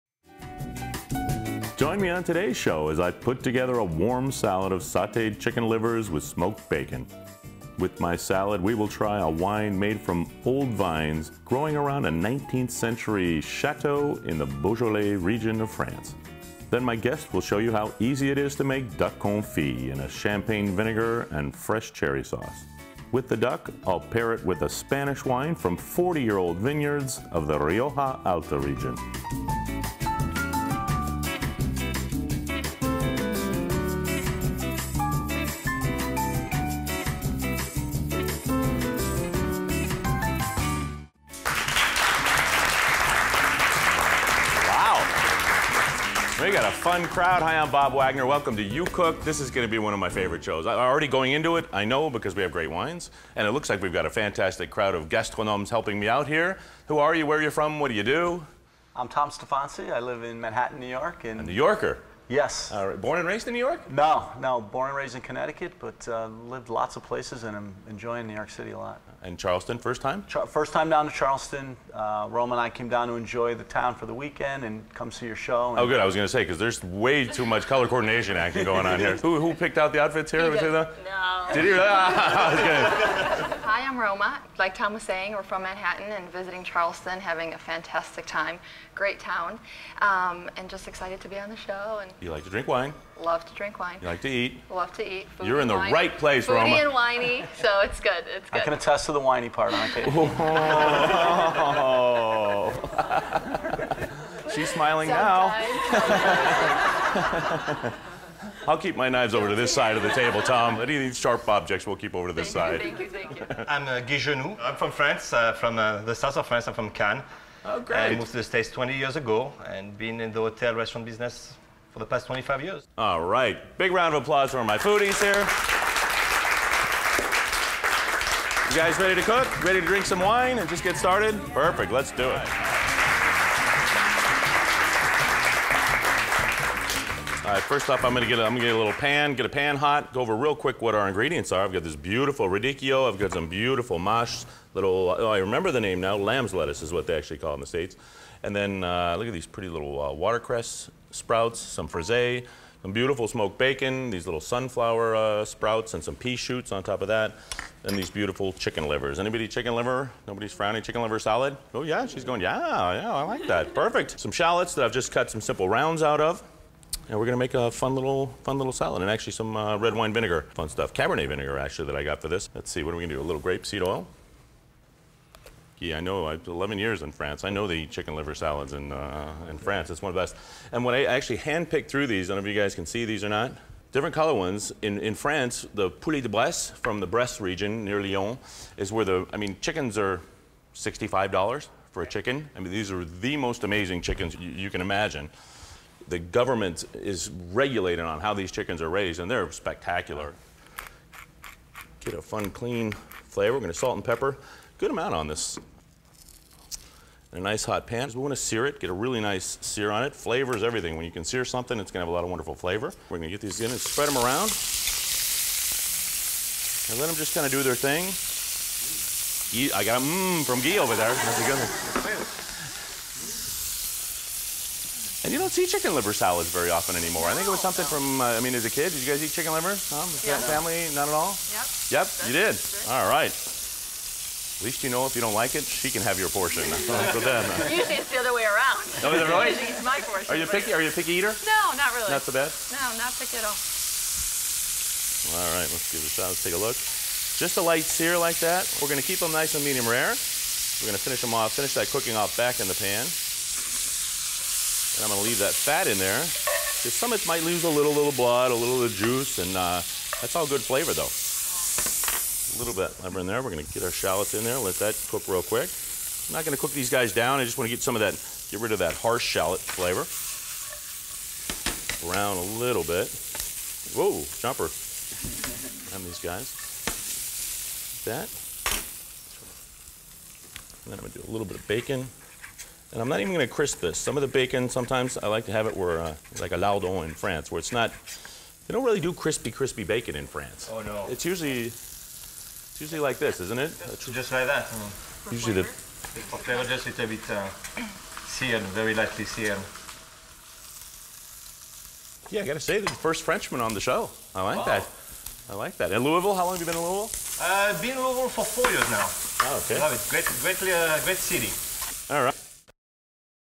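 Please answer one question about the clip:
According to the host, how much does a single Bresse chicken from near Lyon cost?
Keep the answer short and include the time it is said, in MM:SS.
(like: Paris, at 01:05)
$65, at 03:10.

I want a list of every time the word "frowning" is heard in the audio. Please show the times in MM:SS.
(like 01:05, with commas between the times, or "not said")
02:40.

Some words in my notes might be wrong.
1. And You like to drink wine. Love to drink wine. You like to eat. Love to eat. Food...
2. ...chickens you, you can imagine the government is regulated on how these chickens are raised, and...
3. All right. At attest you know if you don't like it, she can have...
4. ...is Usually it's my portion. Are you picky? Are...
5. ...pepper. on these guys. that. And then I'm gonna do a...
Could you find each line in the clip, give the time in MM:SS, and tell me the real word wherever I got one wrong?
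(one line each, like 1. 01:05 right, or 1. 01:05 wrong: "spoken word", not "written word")
1. 01:32 right
2. 03:14 right
3. 03:52 wrong: "least", not "attest"
4. 03:59 right
5. 04:34 wrong: "jumper", not "pepper".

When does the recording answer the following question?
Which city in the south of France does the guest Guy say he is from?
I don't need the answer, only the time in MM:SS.
01:56.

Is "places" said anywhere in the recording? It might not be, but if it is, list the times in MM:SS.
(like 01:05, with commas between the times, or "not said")
01:07, 01:36.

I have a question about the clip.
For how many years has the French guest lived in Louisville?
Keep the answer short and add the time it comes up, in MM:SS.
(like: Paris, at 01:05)
4 years, at 05:08.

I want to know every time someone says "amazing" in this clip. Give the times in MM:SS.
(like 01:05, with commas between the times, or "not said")
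03:13.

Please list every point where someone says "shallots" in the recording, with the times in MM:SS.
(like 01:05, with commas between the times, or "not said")
02:44, 04:23, 04:29.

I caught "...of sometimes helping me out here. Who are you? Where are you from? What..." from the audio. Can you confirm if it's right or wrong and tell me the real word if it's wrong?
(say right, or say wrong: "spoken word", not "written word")
wrong: "gastronomes", not "sometimes".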